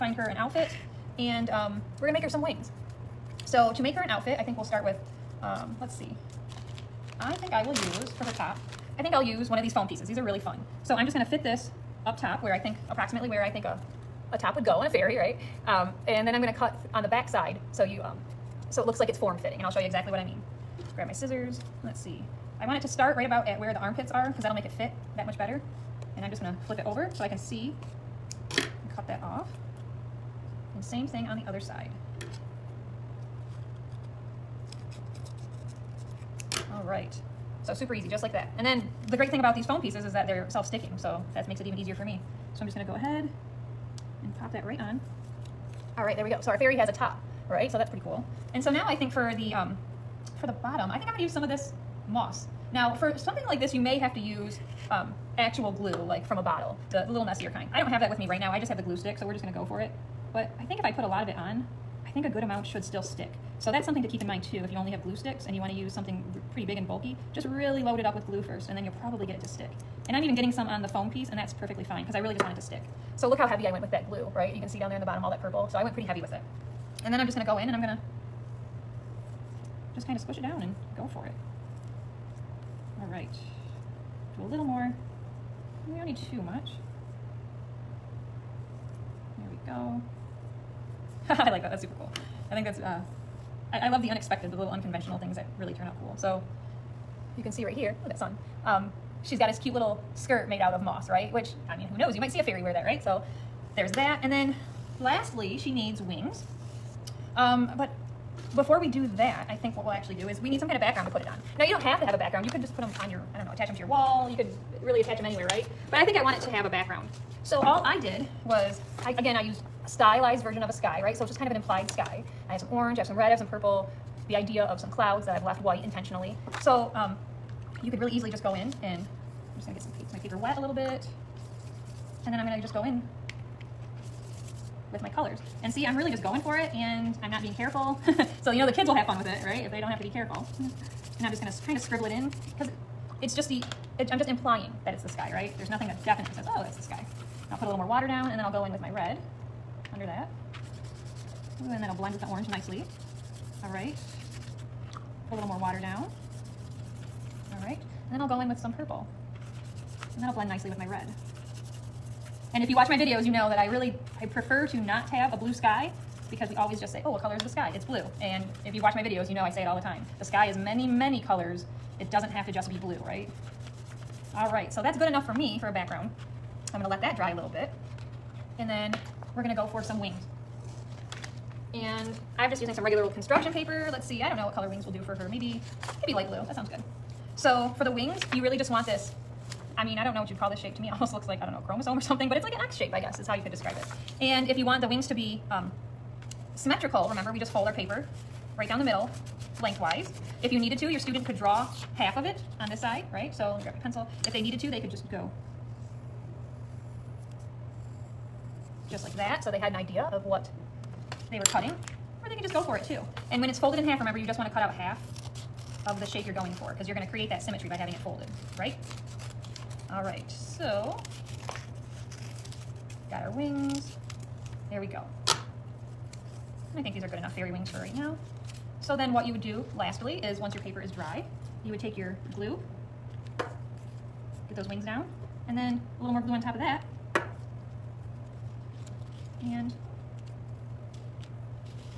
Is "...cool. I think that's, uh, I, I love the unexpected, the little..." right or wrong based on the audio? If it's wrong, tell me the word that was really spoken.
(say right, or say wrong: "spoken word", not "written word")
right.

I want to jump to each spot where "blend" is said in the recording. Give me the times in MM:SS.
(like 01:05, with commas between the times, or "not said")
02:31, 02:40.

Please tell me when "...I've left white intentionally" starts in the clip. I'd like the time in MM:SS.
02:05.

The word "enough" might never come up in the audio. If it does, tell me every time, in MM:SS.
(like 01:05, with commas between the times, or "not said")
02:55, 03:47.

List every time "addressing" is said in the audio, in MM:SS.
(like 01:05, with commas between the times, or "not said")
not said.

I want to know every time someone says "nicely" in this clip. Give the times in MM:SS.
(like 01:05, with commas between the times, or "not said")
02:32, 02:40.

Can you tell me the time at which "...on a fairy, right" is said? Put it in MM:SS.
00:14.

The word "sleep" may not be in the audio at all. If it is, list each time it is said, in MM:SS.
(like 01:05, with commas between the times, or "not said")
not said.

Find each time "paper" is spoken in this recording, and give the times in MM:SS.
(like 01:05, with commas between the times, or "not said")
02:10, 03:03, 03:17, 03:50.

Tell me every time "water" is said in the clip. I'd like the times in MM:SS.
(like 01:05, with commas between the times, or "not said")
02:27, 02:35.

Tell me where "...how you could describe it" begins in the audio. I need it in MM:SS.
03:13.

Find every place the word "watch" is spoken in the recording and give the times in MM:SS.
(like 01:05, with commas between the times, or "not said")
02:42, 02:48.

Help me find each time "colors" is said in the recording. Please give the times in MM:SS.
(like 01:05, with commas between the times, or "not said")
02:15, 02:47, 02:51, 03:04.